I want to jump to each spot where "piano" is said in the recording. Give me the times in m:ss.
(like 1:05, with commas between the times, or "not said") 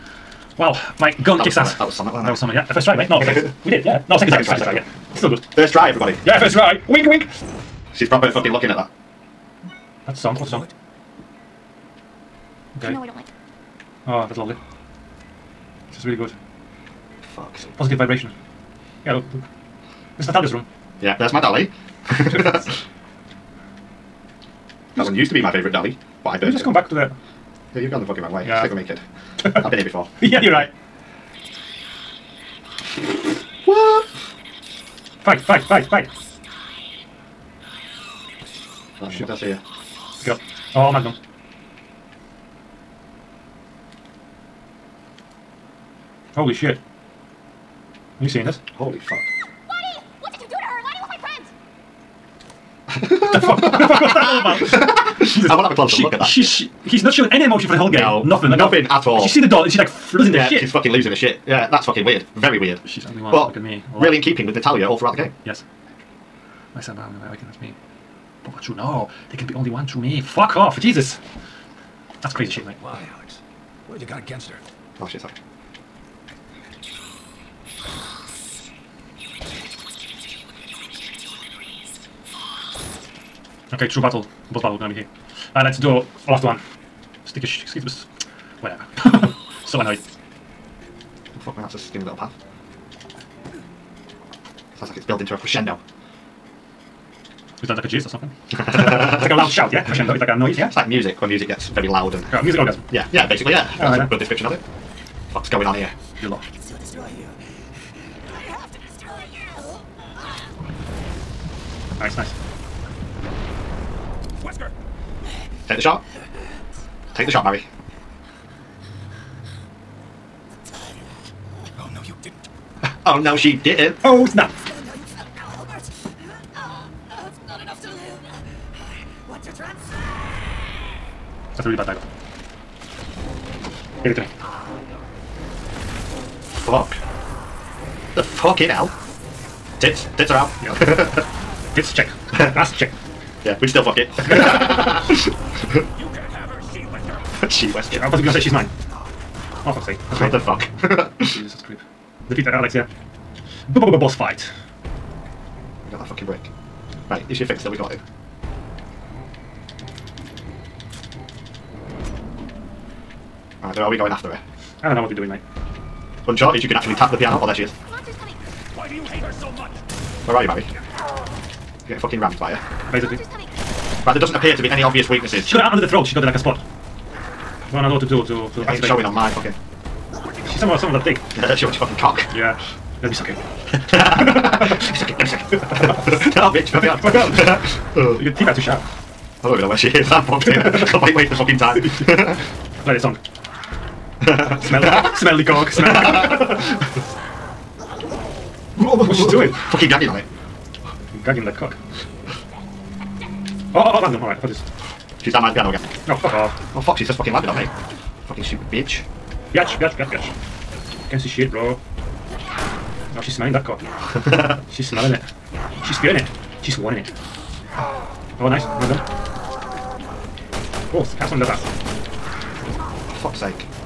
2:47, 3:25.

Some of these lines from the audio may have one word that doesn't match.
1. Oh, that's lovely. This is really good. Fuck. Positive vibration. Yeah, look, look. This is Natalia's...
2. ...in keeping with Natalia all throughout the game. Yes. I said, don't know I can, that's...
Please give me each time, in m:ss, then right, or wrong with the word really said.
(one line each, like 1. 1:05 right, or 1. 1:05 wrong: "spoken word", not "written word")
1. 0:14 right
2. 1:04 right.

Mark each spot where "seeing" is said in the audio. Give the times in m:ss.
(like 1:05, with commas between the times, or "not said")
0:48.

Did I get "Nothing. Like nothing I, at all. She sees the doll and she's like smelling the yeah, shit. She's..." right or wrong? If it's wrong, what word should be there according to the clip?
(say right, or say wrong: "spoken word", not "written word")
wrong: "losing", not "smelling".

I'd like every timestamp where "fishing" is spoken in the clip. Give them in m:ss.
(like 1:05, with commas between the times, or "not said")
not said.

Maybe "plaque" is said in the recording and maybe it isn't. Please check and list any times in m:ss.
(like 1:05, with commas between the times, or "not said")
not said.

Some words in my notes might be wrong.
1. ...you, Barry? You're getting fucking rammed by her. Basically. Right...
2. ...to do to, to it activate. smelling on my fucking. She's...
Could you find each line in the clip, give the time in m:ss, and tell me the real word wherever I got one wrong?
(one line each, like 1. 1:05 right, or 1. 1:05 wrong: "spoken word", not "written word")
1. 2:50 right
2. 2:58 wrong: "showing", not "smelling".